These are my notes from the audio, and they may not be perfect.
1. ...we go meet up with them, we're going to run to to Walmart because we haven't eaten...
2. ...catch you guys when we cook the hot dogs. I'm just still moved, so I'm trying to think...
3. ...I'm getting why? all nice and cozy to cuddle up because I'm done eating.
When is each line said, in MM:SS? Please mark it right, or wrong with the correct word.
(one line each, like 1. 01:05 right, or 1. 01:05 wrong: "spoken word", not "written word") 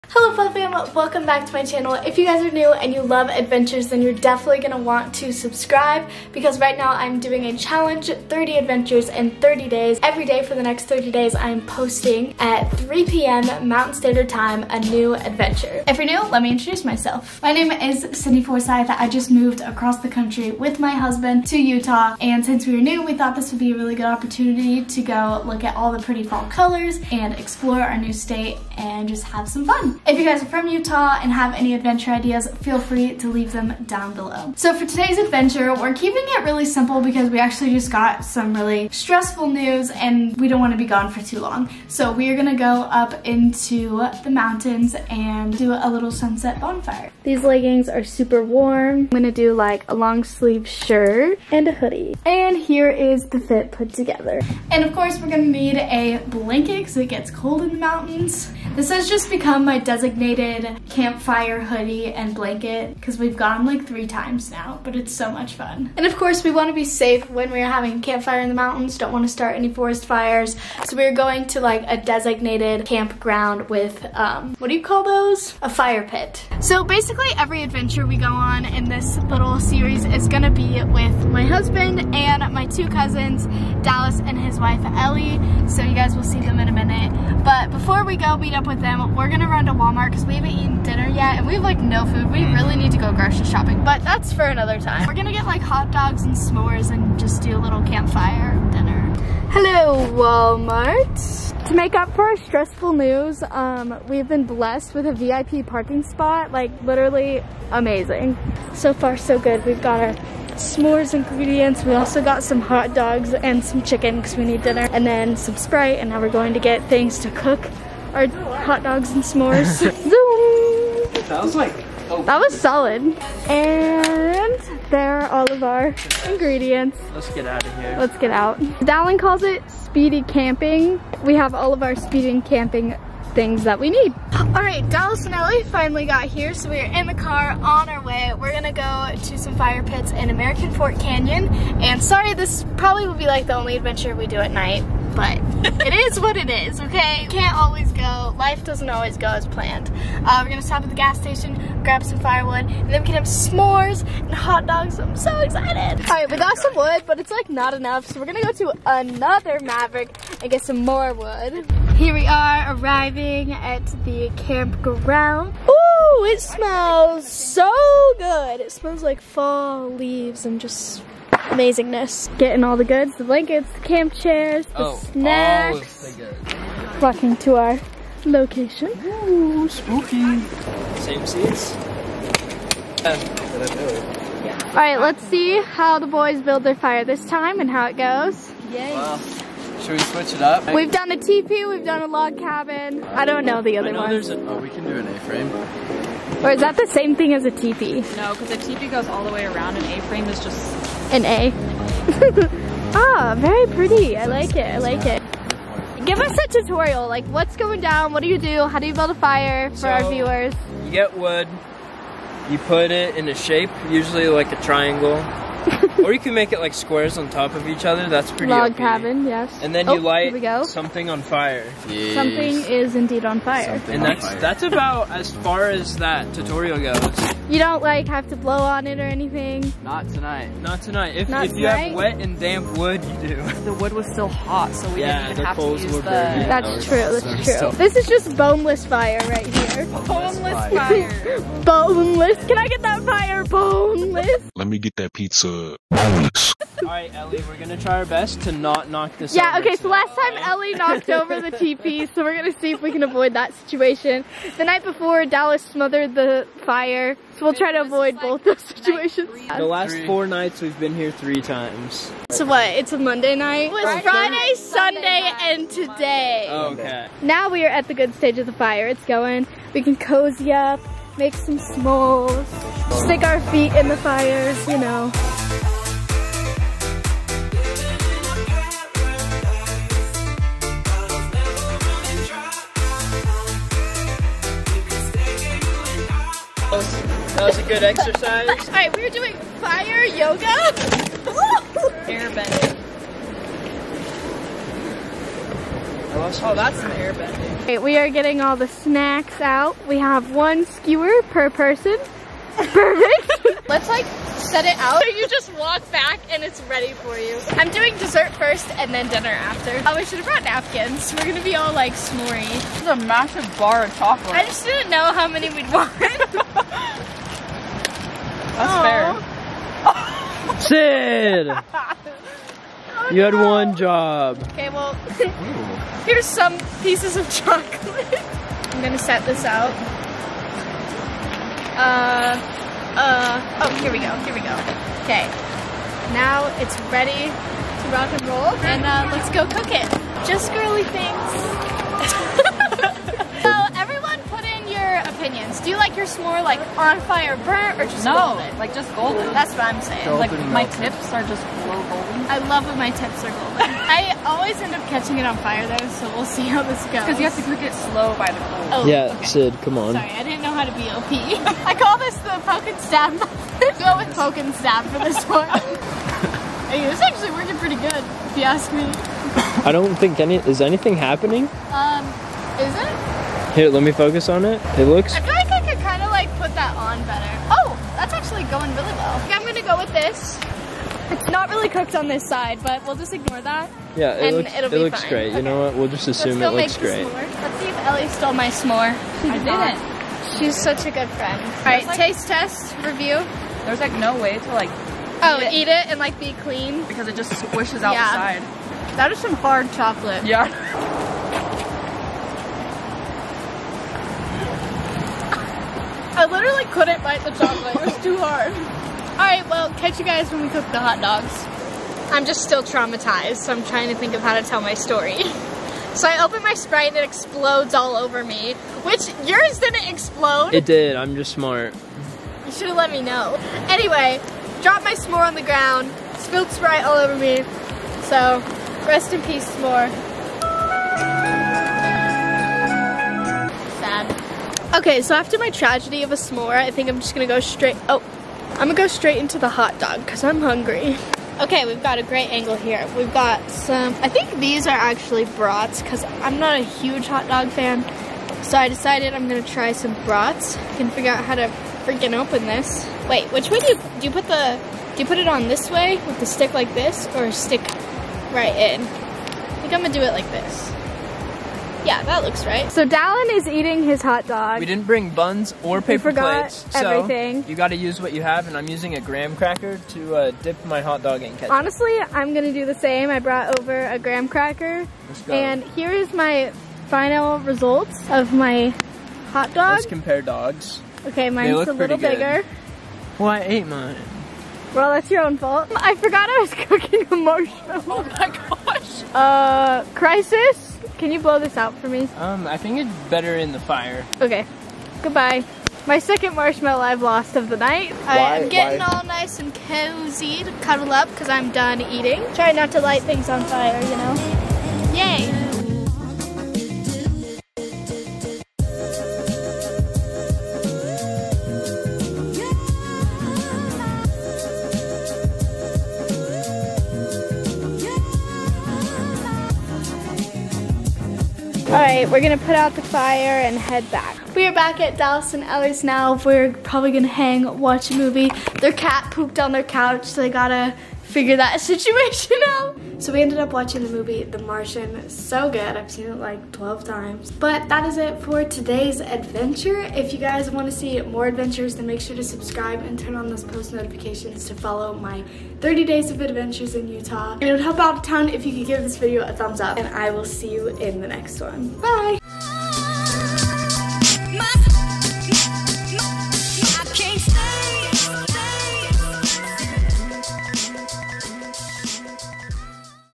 1. 01:28 right
2. 06:49 wrong: "traumatized", not "moved"
3. 08:18 right.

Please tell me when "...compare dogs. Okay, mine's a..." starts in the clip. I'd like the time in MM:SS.
07:59.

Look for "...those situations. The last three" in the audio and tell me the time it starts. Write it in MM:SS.
04:18.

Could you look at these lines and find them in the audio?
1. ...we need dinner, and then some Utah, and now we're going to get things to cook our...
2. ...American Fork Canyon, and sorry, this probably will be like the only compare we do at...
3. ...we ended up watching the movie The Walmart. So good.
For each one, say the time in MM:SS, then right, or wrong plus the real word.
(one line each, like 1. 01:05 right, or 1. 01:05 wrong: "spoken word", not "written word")
1. 01:54 wrong: "Sprite", not "Utah"
2. 02:20 wrong: "adventure", not "compare"
3. 08:53 wrong: "Martian", not "Walmart".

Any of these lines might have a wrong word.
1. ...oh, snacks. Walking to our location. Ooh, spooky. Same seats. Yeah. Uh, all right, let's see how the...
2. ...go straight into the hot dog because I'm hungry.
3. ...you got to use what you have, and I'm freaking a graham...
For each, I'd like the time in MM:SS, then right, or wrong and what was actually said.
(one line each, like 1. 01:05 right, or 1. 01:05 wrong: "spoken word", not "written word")
1. 02:54 right
2. 07:18 right
3. 07:47 wrong: "using", not "freaking".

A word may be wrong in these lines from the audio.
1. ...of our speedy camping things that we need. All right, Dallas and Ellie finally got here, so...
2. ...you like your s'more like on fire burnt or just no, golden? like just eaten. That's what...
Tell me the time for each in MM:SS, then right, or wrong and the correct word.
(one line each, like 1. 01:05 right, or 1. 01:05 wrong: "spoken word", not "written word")
1. 02:11 right
2. 05:45 wrong: "golden", not "eaten".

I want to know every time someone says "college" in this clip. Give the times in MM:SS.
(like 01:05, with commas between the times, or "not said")
not said.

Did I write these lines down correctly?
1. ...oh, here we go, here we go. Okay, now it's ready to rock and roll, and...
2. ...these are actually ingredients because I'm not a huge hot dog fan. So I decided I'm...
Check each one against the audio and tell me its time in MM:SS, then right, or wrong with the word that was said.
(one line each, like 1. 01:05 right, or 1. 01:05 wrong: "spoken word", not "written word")
1. 05:33 right
2. 07:24 wrong: "brats", not "ingredients".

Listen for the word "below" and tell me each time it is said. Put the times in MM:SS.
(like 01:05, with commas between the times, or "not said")
00:34.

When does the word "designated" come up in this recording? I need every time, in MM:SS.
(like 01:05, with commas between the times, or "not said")
00:59, 01:11.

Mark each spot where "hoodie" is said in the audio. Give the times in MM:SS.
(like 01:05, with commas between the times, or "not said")
00:51, 01:01.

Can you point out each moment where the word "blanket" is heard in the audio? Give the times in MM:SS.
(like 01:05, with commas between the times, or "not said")
00:56, 01:02, 02:53.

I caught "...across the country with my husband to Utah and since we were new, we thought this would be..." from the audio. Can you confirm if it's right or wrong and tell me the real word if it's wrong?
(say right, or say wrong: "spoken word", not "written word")
right.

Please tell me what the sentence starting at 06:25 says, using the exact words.
We'll just assume Let's it looks great.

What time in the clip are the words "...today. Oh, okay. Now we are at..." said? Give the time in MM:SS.
04:25.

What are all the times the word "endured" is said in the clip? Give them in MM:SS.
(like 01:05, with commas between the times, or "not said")
not said.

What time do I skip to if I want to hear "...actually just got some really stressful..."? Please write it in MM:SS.
00:37.